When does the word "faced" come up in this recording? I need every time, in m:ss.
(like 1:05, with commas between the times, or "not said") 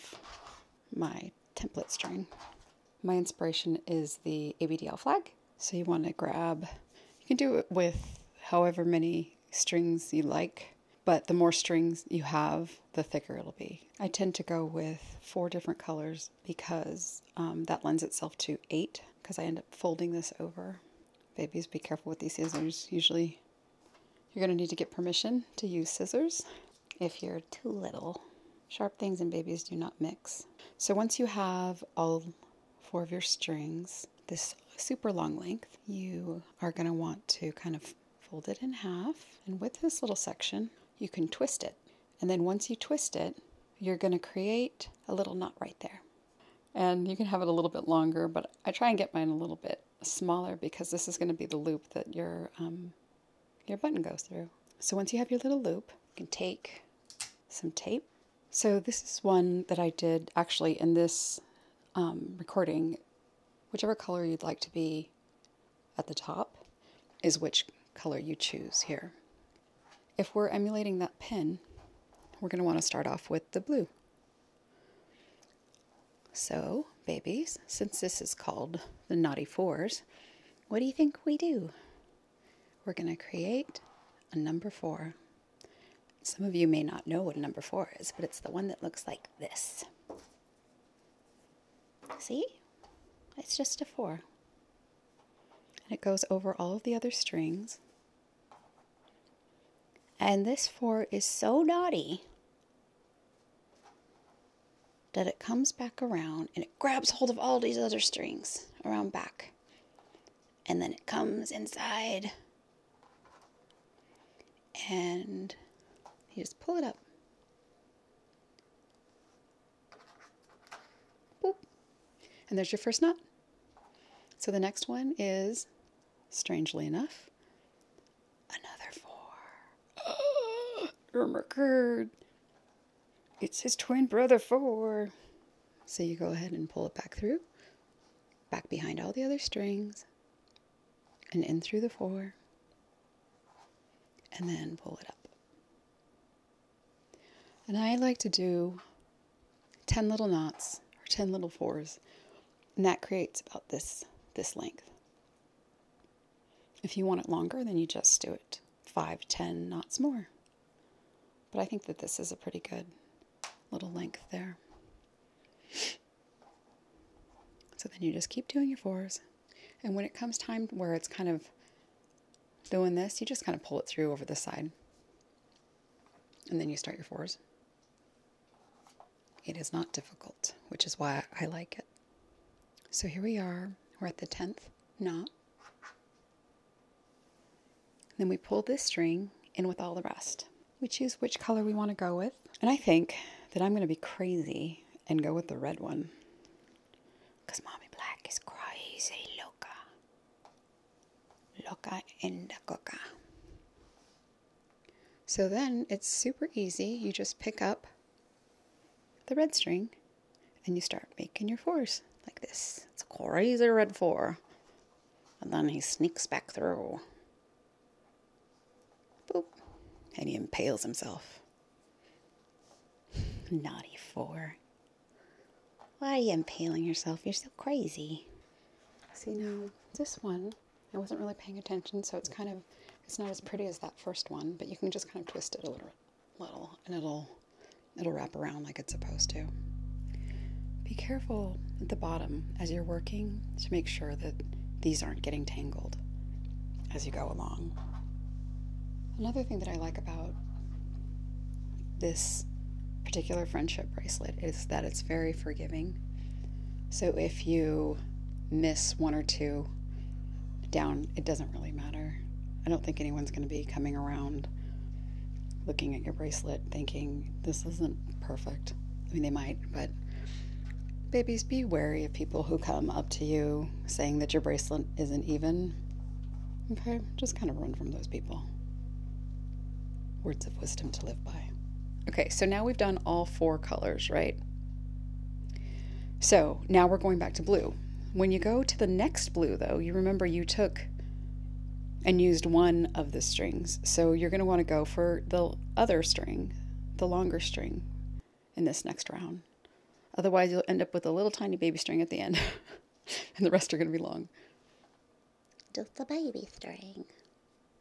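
not said.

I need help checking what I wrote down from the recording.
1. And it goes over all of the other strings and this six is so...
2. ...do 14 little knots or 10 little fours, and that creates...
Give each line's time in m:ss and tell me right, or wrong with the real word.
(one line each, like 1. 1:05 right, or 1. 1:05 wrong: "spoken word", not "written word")
1. 1:35 wrong: "four", not "six"
2. 2:28 wrong: "10", not "14".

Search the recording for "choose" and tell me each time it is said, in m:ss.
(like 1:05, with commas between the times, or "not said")
1:08, 3:10.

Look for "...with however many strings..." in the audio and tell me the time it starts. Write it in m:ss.
0:07.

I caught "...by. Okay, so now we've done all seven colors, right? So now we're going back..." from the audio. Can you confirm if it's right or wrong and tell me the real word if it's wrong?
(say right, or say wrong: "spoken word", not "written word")
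wrong: "four", not "seven".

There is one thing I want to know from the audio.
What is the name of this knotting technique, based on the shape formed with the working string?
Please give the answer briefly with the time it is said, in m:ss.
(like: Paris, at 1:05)
Naughty Fours, at 1:19.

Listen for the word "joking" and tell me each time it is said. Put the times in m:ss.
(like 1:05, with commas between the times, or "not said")
not said.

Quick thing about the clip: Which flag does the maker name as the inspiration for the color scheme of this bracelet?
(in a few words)
ABDL flag.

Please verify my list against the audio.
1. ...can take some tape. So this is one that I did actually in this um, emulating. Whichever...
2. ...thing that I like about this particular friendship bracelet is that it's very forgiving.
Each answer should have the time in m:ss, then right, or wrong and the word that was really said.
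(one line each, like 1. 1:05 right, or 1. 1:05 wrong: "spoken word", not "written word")
1. 0:56 wrong: "recording", not "emulating"
2. 4:09 right.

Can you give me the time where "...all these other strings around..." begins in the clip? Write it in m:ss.
1:47.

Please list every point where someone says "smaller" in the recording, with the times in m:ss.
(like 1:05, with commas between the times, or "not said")
0:50.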